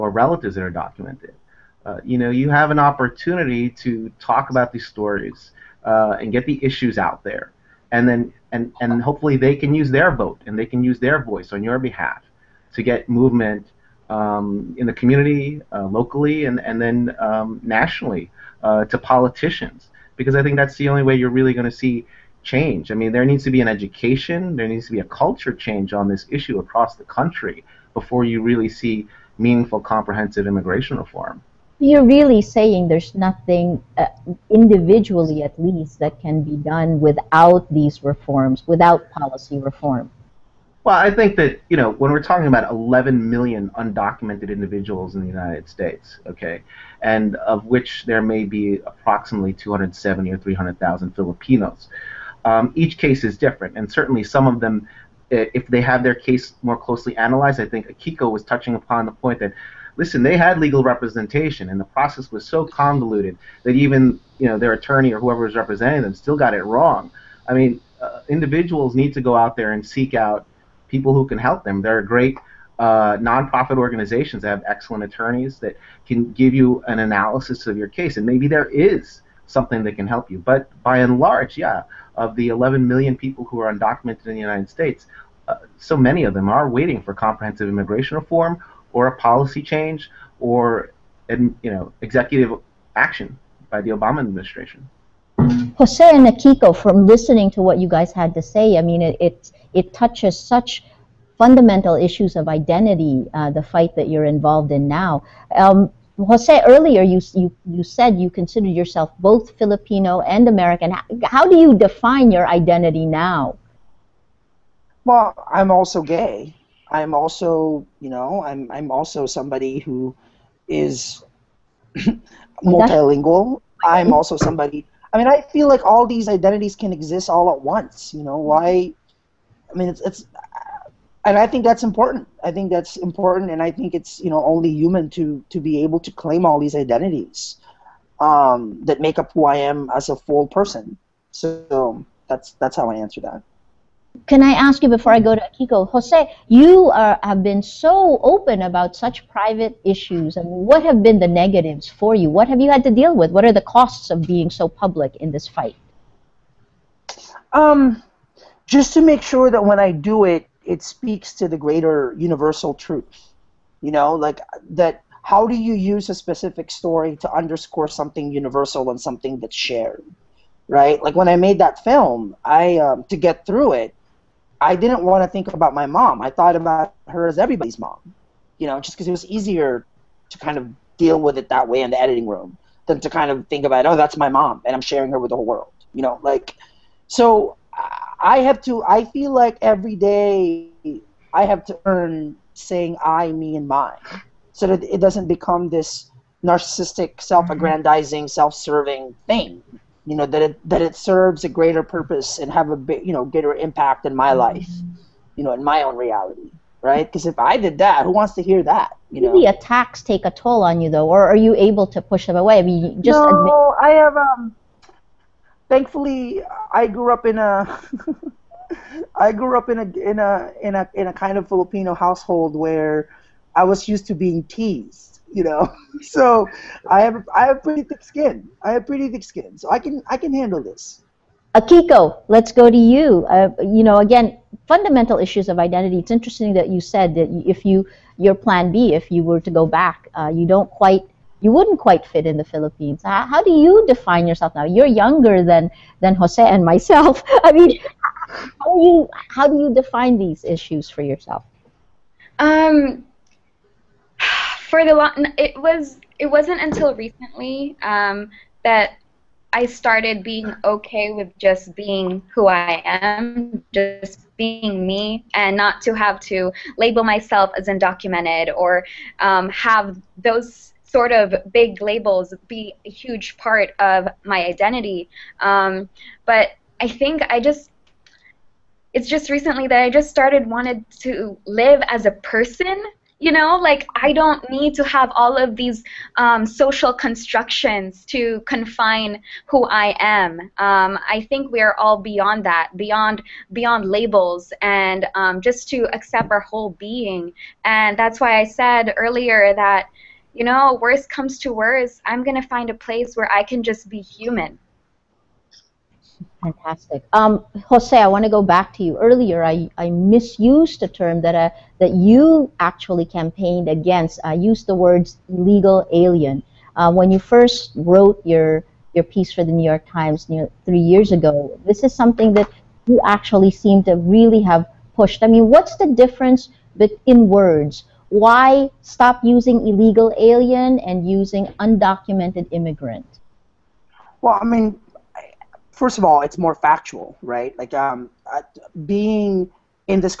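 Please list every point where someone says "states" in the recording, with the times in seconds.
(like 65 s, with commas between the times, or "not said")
45 s, 84 s.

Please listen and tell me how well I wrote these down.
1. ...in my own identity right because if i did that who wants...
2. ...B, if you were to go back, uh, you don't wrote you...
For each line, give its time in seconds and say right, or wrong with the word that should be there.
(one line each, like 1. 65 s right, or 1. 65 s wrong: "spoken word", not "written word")
1. 205 s wrong: "reality", not "identity"
2. 238 s wrong: "quite", not "wrote".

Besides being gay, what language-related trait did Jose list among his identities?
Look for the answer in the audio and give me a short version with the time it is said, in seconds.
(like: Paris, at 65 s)
Multilingual, at 122 s.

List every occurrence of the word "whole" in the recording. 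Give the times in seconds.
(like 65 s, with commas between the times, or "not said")
185 s, 296 s.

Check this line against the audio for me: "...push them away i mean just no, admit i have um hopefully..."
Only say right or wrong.
wrong.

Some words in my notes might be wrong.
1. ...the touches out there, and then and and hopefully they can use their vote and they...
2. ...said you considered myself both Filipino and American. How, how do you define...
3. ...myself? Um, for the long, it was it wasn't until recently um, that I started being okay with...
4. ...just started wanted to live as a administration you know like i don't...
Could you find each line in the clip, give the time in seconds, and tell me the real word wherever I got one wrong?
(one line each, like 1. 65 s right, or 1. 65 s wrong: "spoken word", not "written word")
1. 6 s wrong: "issues", not "touches"
2. 107 s wrong: "yourself", not "myself"
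3. 251 s wrong: "yourself", not "myself"
4. 279 s wrong: "person", not "administration".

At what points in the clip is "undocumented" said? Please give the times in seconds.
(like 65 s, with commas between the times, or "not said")
43 s, 83 s, 267 s, 331 s.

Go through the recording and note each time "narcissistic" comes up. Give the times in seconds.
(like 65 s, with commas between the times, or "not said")
196 s.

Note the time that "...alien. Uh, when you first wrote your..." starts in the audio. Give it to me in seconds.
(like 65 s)
315 s.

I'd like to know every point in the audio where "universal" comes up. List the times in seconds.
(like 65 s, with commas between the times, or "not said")
162 s, 168 s.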